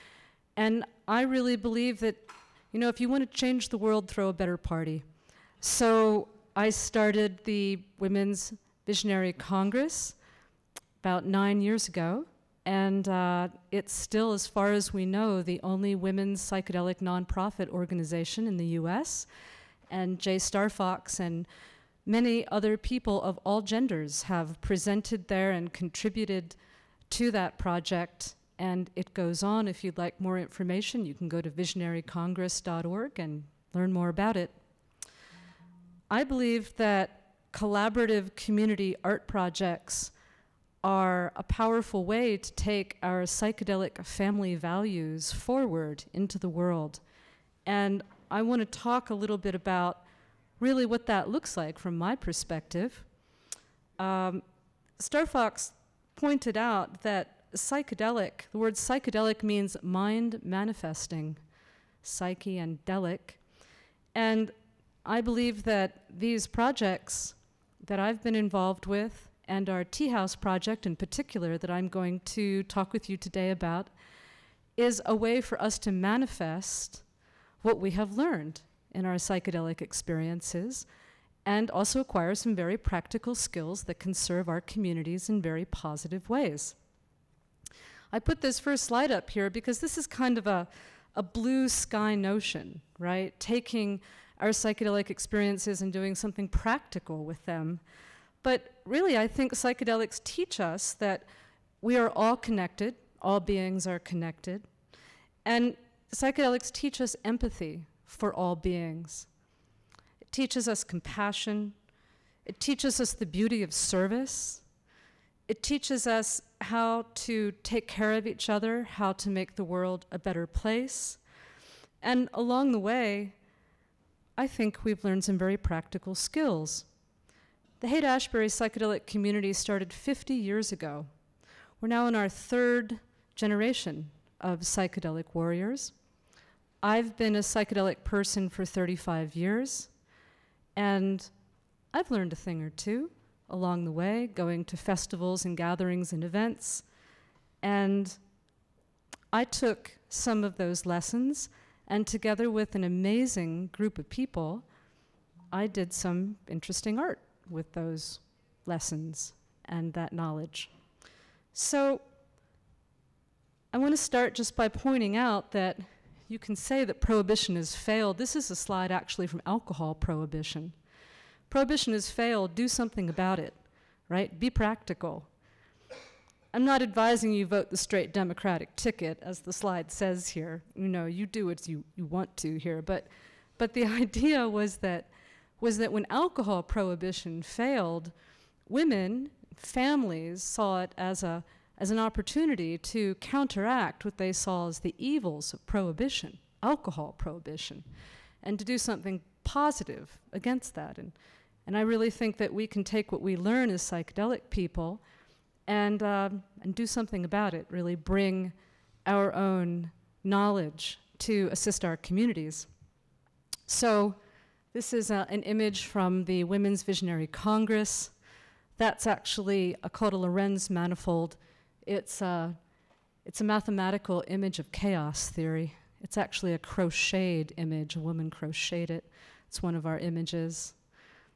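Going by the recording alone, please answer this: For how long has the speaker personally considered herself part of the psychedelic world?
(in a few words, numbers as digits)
35 years.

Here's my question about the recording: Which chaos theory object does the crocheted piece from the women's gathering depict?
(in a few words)
Lorenz manifold.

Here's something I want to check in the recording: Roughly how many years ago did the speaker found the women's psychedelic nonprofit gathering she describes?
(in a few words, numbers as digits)
9 years.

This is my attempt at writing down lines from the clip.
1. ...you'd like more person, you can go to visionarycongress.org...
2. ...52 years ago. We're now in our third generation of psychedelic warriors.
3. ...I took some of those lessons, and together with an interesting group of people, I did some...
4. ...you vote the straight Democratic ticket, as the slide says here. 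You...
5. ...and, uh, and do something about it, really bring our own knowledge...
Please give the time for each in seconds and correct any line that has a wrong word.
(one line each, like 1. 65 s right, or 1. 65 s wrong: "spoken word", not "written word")
1. 29 s wrong: "information", not "person"
2. 129 s wrong: "50", not "52"
3. 149 s wrong: "amazing", not "interesting"
4. 177 s right
5. 205 s right.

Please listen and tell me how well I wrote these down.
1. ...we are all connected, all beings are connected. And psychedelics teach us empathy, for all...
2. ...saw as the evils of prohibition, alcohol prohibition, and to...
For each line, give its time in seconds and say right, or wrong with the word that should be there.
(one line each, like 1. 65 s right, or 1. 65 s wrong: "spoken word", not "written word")
1. 101 s right
2. 194 s right.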